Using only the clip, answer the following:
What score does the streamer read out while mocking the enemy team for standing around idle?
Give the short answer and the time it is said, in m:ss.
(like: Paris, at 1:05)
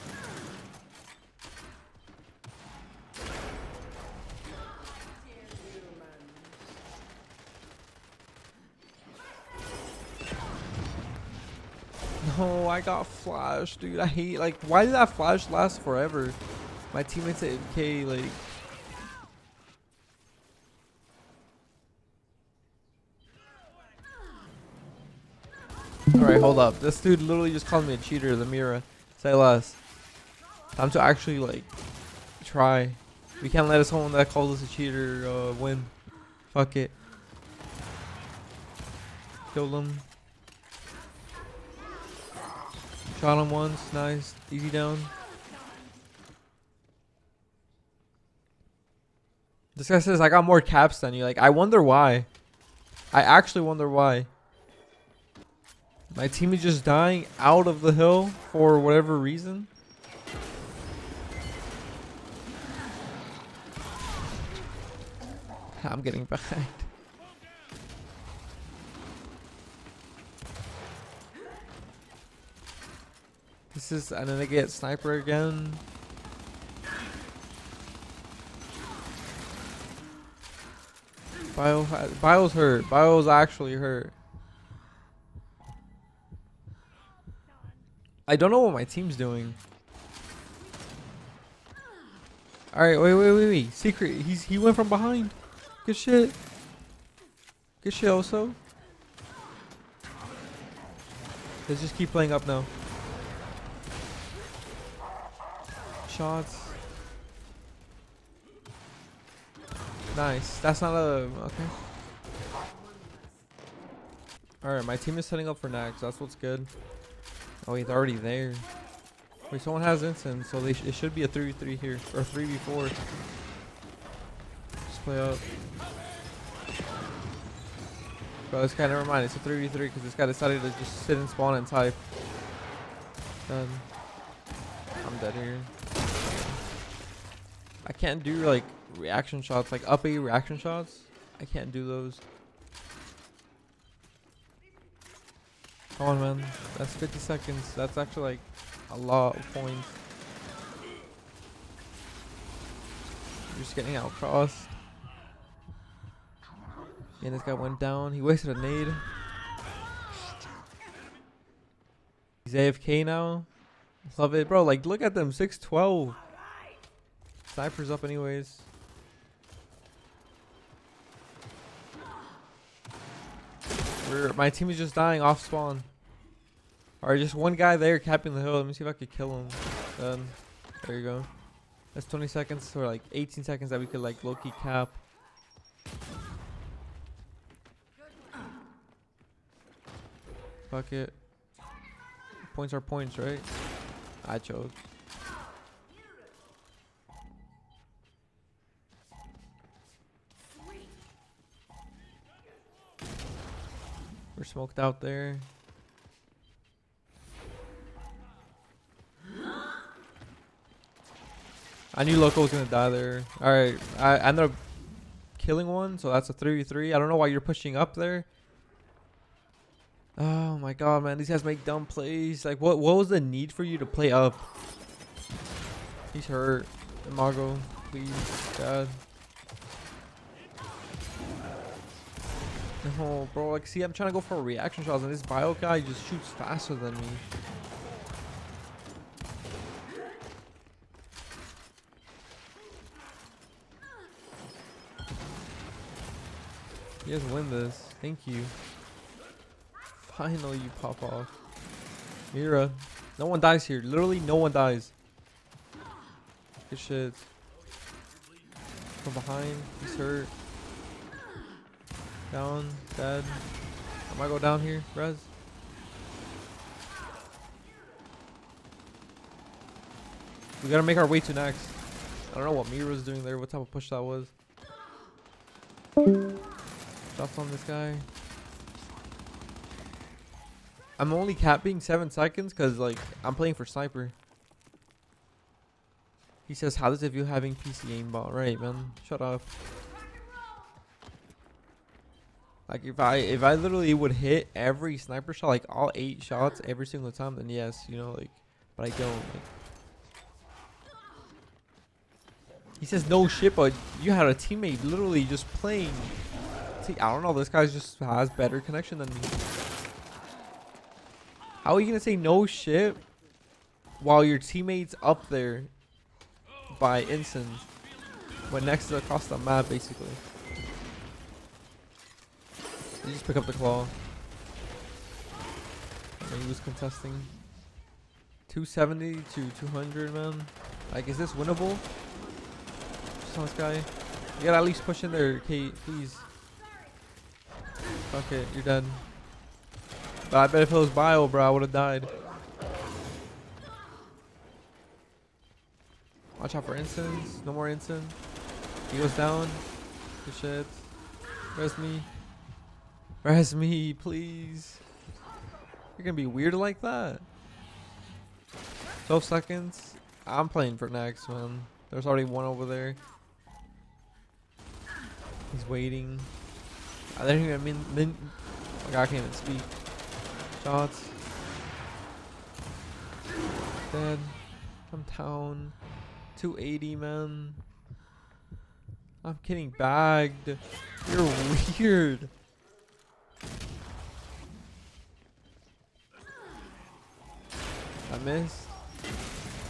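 612, at 2:45.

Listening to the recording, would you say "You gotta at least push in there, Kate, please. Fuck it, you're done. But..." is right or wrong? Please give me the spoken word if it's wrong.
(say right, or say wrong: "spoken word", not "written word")
right.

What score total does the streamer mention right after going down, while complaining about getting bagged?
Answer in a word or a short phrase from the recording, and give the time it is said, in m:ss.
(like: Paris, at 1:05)
280, at 6:16.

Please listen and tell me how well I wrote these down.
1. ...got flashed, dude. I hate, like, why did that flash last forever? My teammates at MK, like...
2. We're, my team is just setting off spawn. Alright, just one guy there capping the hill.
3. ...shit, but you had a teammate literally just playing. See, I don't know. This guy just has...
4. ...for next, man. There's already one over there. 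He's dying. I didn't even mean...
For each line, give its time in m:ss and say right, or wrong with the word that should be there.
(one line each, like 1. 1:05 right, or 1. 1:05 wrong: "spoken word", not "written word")
1. 0:12 right
2. 2:54 wrong: "dying", not "setting"
3. 5:03 right
4. 6:00 wrong: "waiting", not "dying".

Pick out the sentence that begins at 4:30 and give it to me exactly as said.
We gotta make our way to next.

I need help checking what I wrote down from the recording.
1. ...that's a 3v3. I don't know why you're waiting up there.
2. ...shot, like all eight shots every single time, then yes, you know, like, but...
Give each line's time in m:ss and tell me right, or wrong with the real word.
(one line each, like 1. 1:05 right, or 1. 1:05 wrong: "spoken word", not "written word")
1. 3:36 wrong: "pushing", not "waiting"
2. 4:55 right.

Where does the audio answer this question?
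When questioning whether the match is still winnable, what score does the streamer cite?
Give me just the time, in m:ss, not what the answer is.
5:28.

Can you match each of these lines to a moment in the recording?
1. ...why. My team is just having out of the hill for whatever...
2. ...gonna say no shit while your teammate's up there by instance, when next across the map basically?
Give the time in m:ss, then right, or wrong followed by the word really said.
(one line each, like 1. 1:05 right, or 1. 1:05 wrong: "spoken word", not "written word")
1. 0:53 wrong: "dying", not "having"
2. 5:11 right.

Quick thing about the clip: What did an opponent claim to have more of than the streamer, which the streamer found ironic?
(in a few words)
caps.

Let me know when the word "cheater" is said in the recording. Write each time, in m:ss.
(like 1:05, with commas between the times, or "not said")
0:27, 0:34.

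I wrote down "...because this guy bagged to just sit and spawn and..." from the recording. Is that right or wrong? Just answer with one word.
wrong.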